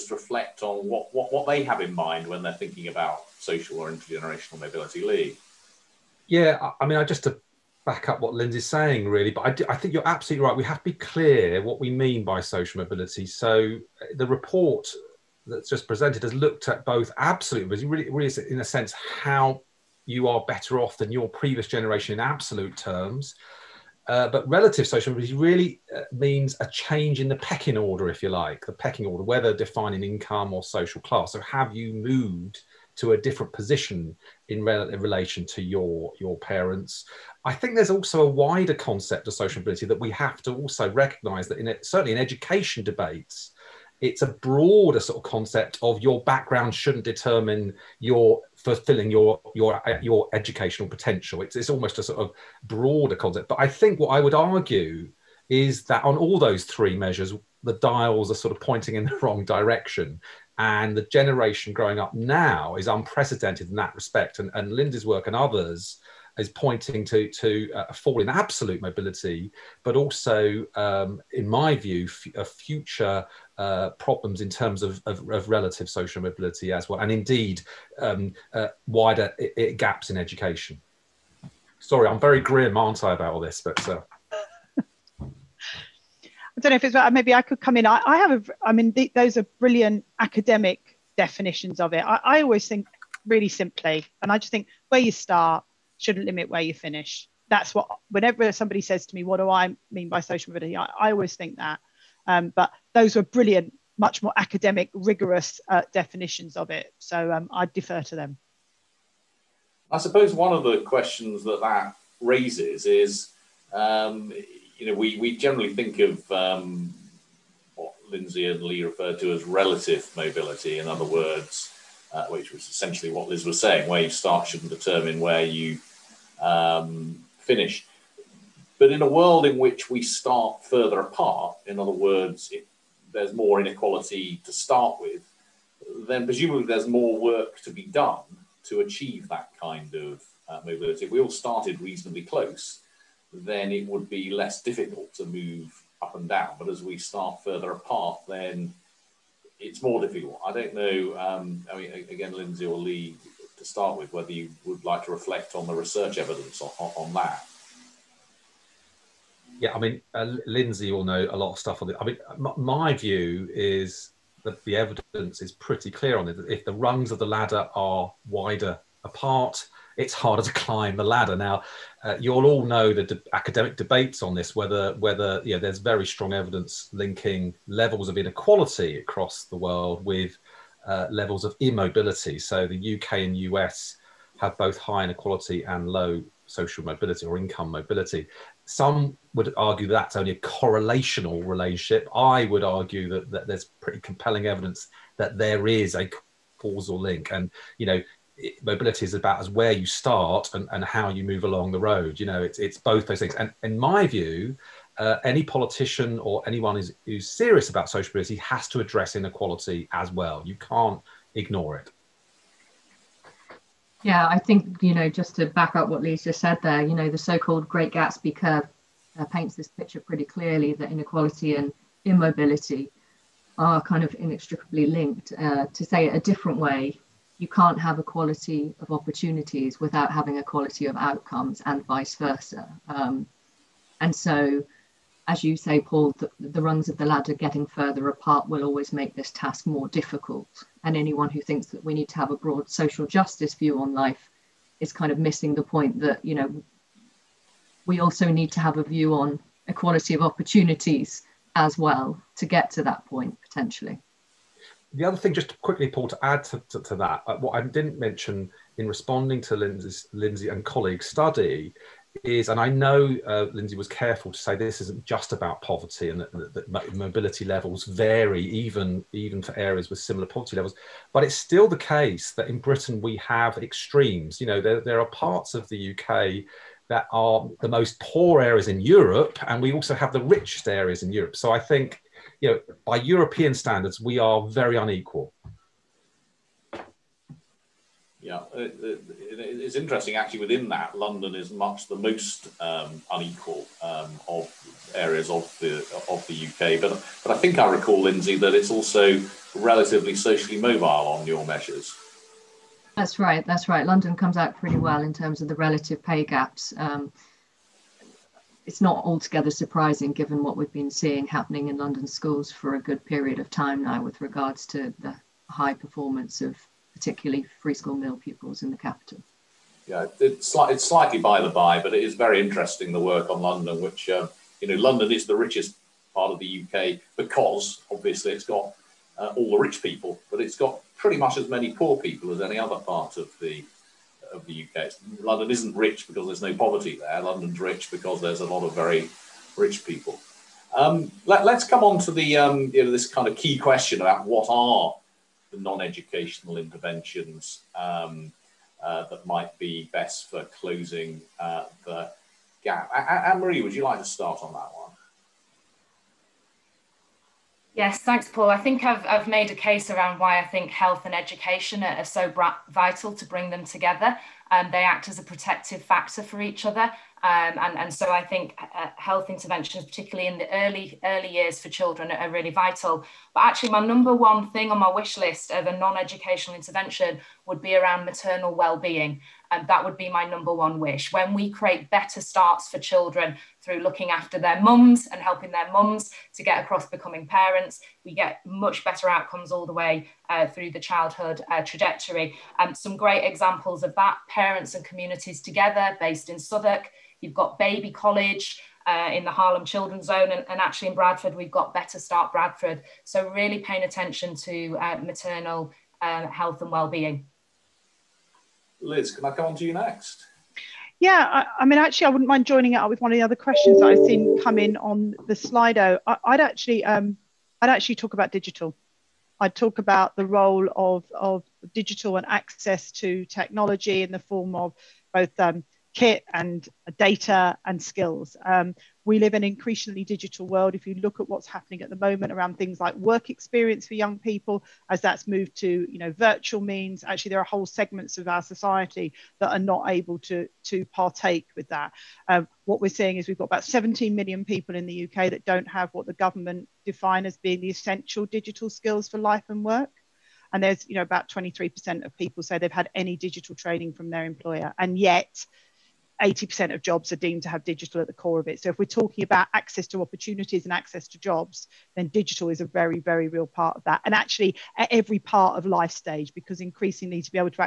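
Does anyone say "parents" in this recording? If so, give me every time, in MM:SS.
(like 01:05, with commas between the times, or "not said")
00:36, 06:27, 06:34.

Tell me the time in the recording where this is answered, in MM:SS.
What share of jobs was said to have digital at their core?
07:36.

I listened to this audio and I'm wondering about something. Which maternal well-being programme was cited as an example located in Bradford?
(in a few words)
Better Start Bradford.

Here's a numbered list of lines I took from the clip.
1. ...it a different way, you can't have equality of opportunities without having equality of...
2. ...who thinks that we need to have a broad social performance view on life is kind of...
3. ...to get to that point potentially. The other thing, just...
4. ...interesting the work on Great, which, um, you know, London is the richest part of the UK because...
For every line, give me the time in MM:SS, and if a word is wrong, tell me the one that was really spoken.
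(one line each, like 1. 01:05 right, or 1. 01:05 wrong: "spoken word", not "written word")
1. 03:46 right
2. 04:01 wrong: "justice", not "performance"
3. 04:12 right
4. 05:22 wrong: "London", not "Great".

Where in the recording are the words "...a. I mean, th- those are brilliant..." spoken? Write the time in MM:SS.
01:28.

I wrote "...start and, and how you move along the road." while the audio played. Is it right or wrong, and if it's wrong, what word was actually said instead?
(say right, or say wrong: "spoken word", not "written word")
right.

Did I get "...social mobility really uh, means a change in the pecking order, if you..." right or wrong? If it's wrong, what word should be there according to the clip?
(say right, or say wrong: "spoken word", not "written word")
right.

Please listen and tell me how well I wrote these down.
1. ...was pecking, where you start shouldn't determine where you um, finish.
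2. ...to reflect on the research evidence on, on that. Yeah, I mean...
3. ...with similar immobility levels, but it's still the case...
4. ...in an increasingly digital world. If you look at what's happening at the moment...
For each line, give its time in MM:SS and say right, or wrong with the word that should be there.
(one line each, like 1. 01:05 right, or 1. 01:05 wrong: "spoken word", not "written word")
1. 02:03 wrong: "saying", not "pecking"
2. 02:35 right
3. 04:29 wrong: "poverty", not "immobility"
4. 07:09 right.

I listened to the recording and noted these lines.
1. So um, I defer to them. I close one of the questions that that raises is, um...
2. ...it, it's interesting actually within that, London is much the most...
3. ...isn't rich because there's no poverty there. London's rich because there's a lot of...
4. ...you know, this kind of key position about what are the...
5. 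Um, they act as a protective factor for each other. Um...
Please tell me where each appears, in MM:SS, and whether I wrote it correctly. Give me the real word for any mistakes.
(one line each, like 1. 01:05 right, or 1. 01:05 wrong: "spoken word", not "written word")
1. 01:46 wrong: "suppose", not "close"
2. 04:48 right
3. 05:35 right
4. 05:42 wrong: "question", not "position"
5. 06:04 right.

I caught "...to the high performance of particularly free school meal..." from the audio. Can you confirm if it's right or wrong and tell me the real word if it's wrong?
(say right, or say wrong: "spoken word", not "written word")
right.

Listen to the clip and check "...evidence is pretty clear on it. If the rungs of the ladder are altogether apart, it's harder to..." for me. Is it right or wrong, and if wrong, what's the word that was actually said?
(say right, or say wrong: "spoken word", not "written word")
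wrong: "wider", not "altogether".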